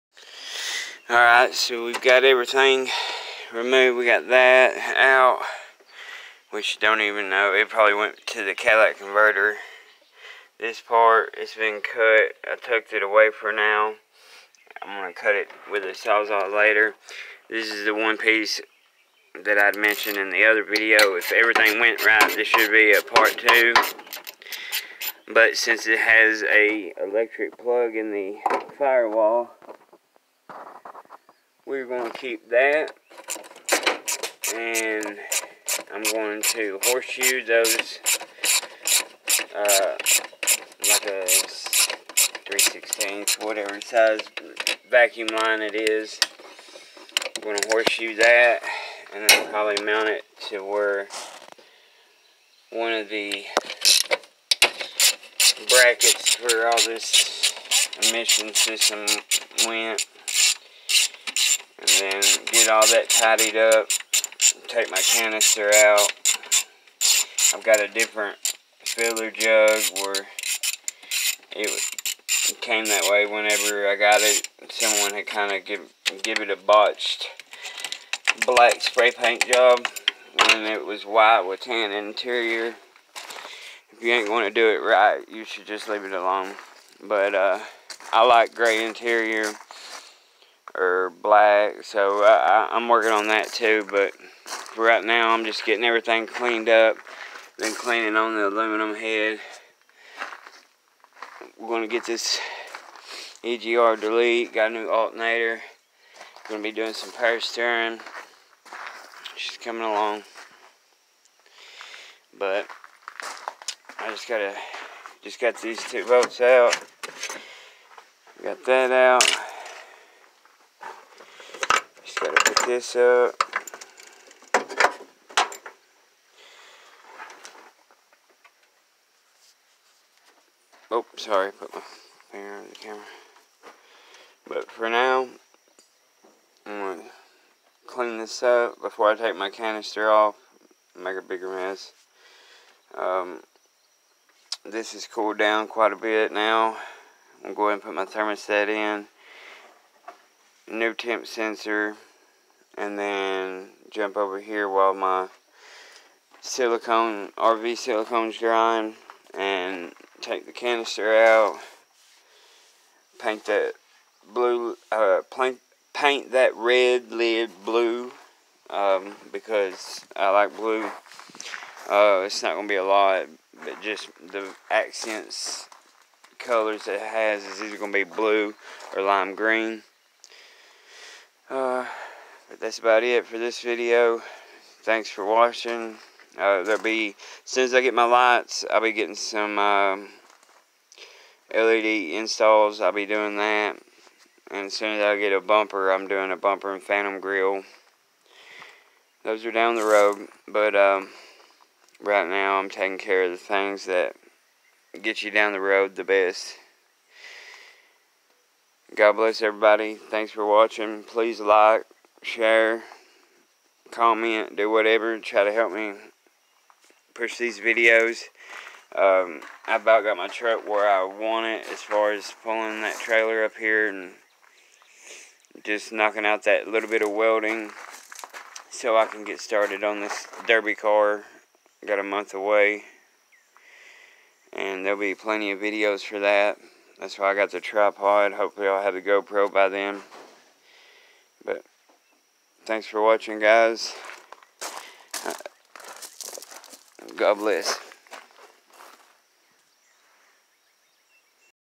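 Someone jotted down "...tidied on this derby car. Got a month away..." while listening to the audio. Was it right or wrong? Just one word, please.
wrong.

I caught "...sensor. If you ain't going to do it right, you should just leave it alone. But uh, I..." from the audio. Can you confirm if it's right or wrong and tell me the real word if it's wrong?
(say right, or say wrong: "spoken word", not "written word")
wrong: "interior", not "sensor".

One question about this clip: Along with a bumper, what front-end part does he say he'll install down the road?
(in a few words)
phantom grill.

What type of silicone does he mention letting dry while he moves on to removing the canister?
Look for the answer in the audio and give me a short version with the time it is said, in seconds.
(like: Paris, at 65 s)
RV silicone, at 157 s.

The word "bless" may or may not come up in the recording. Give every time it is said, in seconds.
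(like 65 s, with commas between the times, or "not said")
209 s, 247 s.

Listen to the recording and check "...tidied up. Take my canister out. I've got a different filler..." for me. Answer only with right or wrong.
right.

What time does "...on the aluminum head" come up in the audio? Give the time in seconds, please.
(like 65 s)
98 s.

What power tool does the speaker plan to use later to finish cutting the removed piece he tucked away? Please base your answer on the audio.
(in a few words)
Sawzall.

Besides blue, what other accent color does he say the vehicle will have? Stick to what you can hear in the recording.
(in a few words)
lime green.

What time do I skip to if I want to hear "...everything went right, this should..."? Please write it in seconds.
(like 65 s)
21 s.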